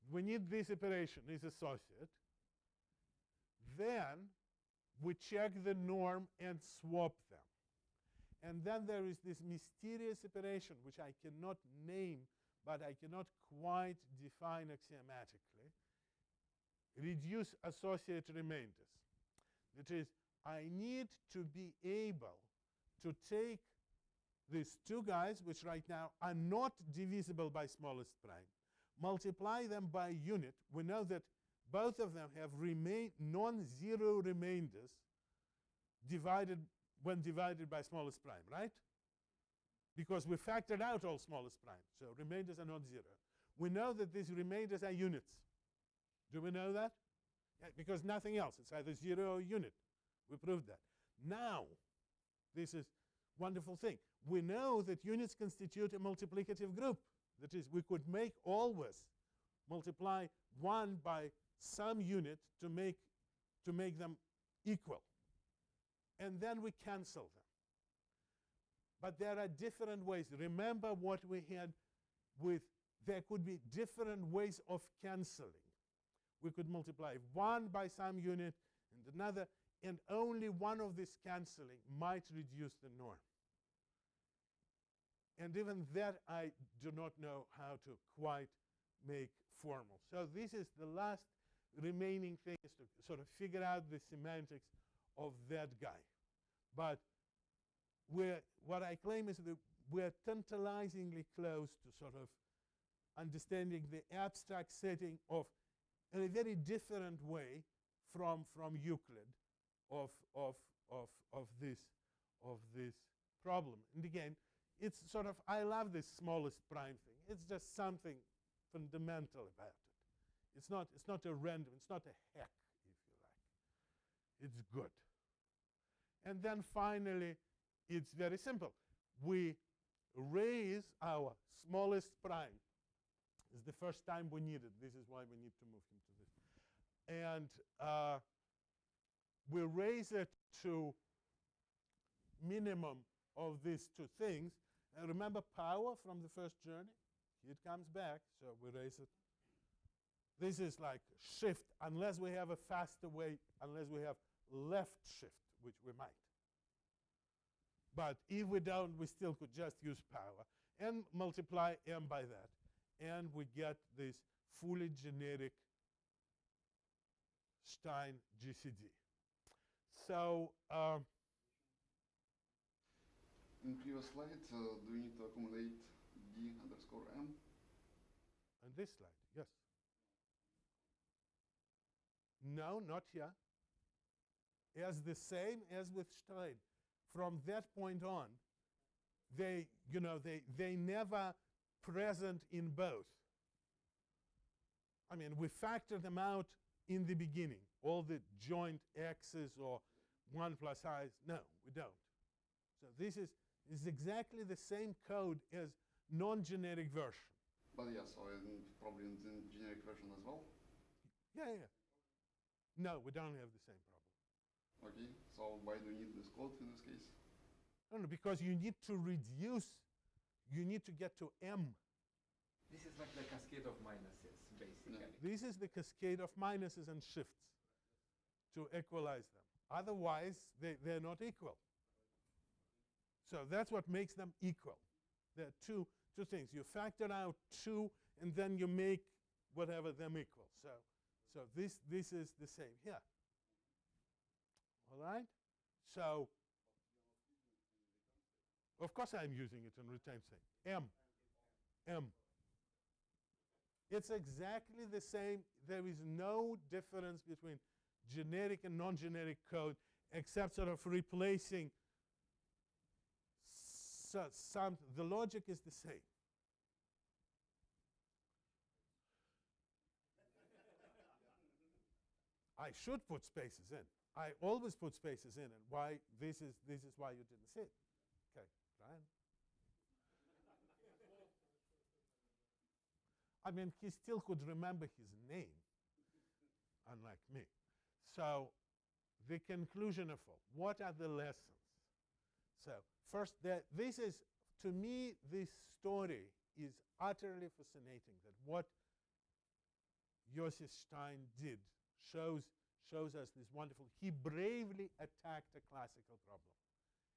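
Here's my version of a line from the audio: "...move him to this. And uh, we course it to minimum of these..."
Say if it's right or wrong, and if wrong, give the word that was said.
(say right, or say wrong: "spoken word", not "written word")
wrong: "raise", not "course".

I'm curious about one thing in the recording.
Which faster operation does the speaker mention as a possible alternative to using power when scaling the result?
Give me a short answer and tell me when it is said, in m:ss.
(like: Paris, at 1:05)
left shift, at 2:34.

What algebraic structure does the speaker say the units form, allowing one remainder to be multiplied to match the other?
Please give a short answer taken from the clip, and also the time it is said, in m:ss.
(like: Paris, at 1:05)
multiplicative group, at 0:55.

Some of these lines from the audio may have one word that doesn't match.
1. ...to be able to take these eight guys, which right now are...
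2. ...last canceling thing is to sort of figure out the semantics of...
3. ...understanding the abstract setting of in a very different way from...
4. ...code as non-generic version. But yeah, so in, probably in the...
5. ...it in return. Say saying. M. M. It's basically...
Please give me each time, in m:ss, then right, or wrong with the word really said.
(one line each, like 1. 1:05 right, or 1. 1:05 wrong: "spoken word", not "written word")
1. 0:21 wrong: "two", not "eight"
2. 1:30 wrong: "remaining", not "canceling"
3. 1:43 right
4. 3:24 right
5. 4:09 wrong: "exactly", not "basically".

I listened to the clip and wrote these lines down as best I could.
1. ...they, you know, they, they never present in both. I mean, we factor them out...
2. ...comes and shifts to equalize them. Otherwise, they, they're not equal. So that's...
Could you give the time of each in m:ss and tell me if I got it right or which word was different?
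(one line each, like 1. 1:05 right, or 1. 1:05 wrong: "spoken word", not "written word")
1. 3:09 right
2. 3:46 wrong: "minuses", not "comes".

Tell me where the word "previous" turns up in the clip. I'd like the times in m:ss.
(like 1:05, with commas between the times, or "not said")
2:53.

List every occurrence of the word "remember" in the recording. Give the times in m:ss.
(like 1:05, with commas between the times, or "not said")
1:10, 2:25, 4:44.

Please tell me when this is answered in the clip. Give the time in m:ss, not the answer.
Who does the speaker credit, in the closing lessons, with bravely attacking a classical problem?
5:00.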